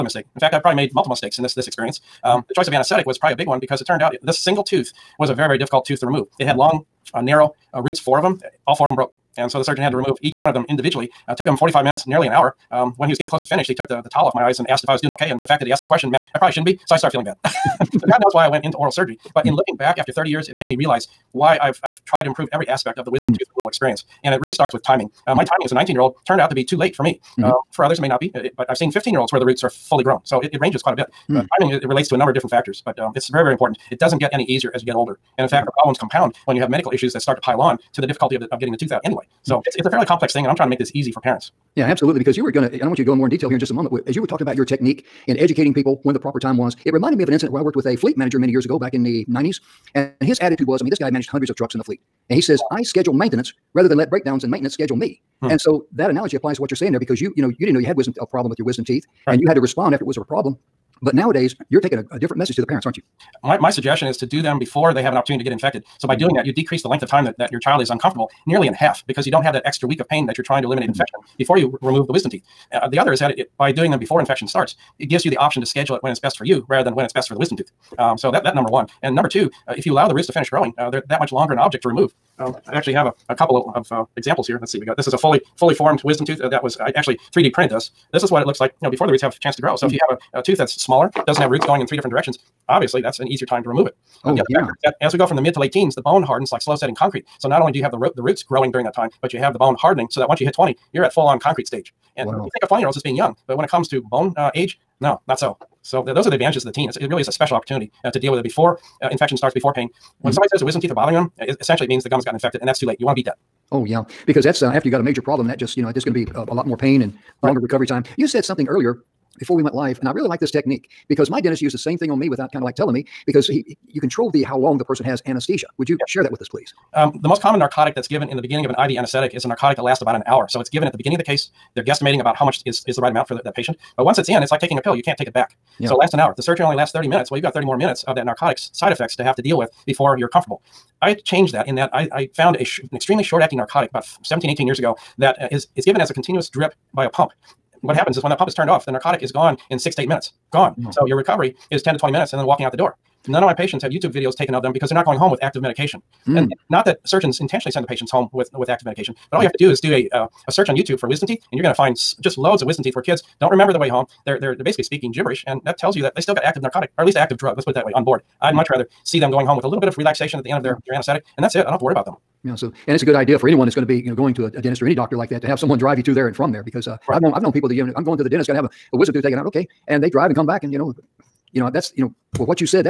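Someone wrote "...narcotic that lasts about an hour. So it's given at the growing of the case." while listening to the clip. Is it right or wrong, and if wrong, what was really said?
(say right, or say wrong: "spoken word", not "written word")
wrong: "beginning", not "growing".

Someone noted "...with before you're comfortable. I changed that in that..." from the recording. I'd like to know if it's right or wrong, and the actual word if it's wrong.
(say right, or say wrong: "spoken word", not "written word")
right.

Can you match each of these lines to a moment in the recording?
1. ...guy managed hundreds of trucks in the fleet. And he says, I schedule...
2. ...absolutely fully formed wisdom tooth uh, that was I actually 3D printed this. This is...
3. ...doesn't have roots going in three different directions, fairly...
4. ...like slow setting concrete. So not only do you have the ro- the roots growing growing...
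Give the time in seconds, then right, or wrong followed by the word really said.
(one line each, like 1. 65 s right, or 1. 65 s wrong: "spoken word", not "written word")
1. 50 s right
2. 85 s wrong: "fully", not "absolutely"
3. 91 s wrong: "obviously", not "fairly"
4. 96 s wrong: "during", not "growing".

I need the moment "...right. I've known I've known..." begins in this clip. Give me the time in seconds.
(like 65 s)
177 s.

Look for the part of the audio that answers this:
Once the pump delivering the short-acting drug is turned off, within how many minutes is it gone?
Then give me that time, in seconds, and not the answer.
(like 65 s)
149 s.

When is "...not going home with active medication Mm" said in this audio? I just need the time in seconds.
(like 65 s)
154 s.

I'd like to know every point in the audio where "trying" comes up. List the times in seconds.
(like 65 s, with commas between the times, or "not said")
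40 s, 70 s.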